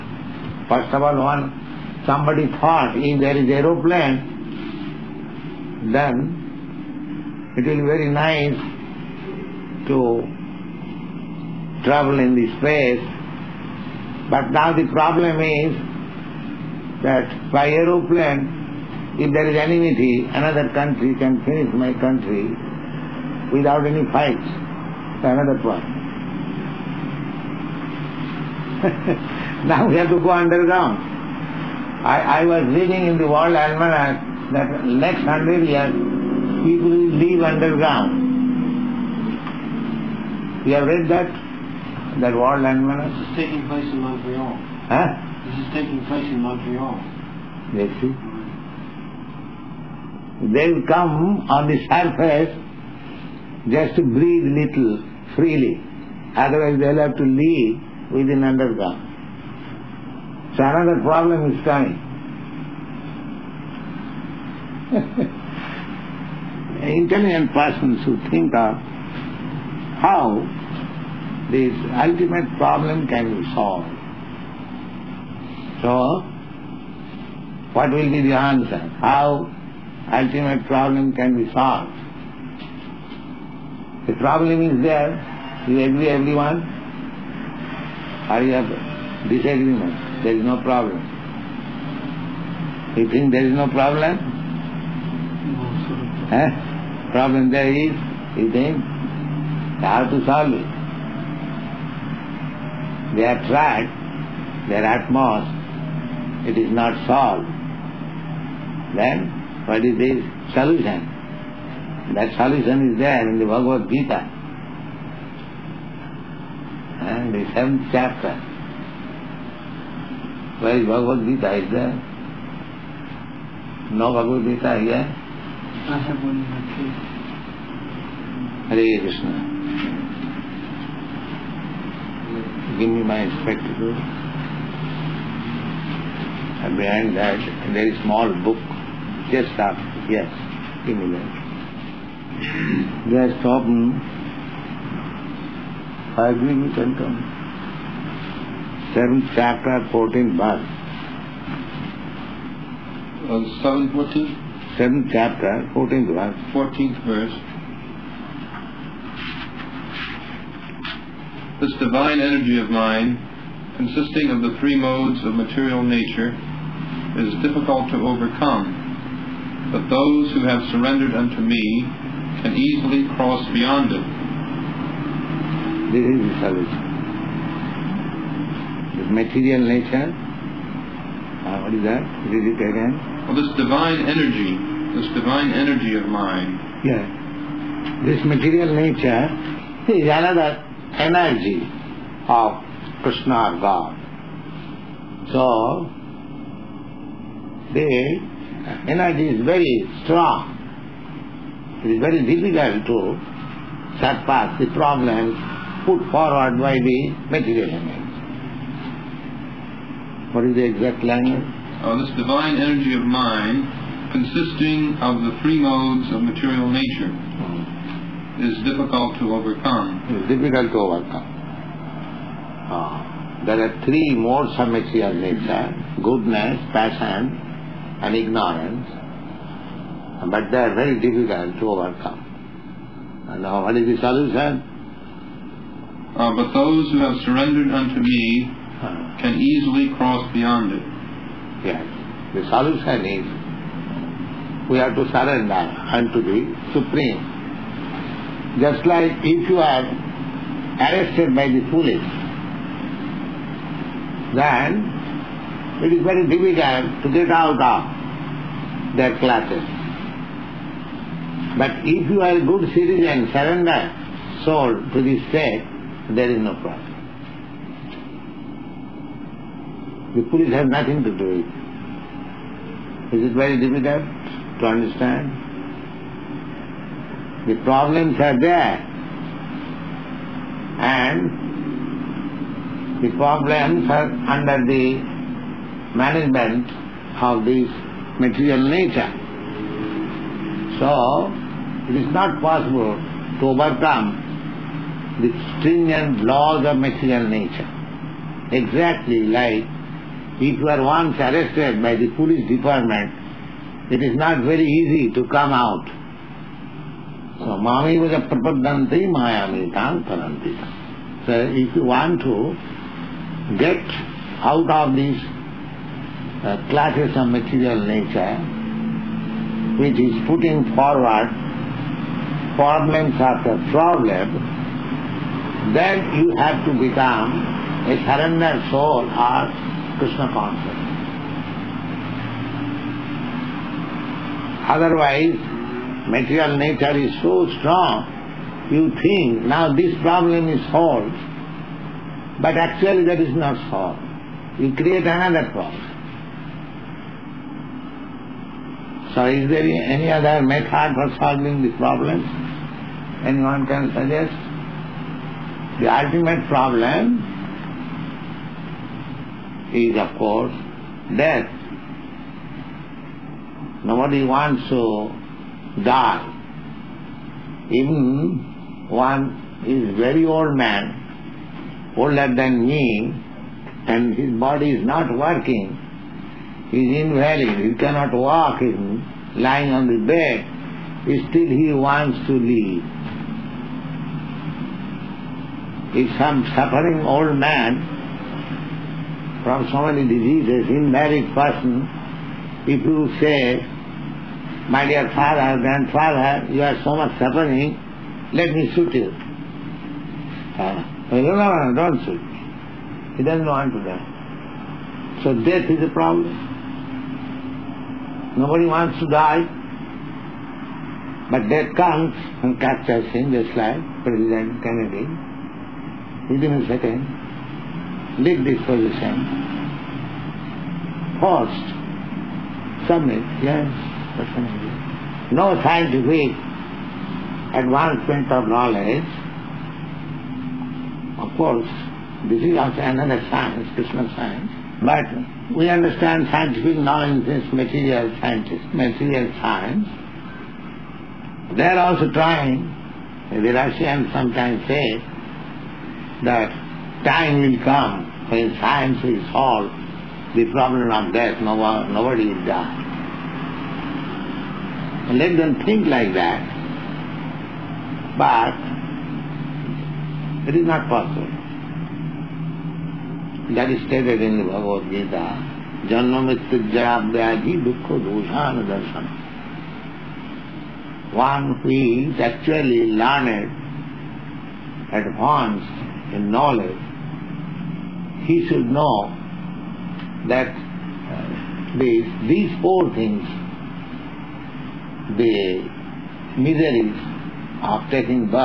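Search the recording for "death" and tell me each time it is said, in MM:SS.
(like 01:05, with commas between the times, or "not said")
06:01, 06:45, 06:51, 07:31.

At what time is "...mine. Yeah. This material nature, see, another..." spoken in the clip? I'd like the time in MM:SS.
03:06.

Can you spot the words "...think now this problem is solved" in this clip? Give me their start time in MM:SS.
05:39.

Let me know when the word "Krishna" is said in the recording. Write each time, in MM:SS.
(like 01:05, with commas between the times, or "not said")
02:09, 03:13, 05:29, 07:13.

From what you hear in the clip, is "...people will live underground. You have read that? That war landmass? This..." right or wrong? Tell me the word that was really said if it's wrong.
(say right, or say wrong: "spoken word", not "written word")
right.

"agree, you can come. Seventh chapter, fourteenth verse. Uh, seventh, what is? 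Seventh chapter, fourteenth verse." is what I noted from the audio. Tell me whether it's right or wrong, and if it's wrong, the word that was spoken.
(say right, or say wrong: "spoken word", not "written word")
right.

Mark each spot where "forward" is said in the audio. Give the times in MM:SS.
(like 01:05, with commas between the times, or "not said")
03:26, 05:20.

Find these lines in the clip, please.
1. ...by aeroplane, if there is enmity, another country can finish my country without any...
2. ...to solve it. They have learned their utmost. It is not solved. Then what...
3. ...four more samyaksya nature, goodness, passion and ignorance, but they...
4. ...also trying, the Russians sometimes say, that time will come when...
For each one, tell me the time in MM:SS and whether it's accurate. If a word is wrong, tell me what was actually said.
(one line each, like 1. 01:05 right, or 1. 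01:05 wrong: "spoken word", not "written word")
1. 00:17 right
2. 01:40 wrong: "tried", not "learned"
3. 03:43 wrong: "three", not "four"
4. 07:21 right.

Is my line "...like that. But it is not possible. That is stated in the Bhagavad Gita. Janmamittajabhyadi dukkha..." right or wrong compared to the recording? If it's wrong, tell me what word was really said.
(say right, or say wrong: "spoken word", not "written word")
right.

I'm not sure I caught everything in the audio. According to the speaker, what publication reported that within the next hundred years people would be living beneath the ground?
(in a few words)
World Almanac.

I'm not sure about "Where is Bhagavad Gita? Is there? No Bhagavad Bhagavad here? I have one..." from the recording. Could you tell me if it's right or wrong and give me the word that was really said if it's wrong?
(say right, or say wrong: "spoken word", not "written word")
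wrong: "Gita", not "Bhagavad".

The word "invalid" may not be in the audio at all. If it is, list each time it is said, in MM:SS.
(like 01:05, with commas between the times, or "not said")
06:17, 06:30.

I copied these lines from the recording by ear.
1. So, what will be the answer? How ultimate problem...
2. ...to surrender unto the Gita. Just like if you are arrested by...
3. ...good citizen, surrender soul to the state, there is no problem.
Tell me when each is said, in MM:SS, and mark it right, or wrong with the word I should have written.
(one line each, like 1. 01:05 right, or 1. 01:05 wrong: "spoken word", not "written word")
1. 01:15 right
2. 04:04 wrong: "Supreme", not "Gita"
3. 04:22 right.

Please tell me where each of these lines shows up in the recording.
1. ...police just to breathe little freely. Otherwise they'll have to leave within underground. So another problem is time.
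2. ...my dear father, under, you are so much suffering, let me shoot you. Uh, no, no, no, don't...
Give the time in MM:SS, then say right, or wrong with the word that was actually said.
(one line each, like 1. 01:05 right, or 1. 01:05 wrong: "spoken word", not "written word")
1. 00:51 wrong: "surface", not "police"
2. 06:34 wrong: "grandfather", not "under".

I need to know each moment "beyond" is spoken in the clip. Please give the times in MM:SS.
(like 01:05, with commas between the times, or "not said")
02:53, 04:00.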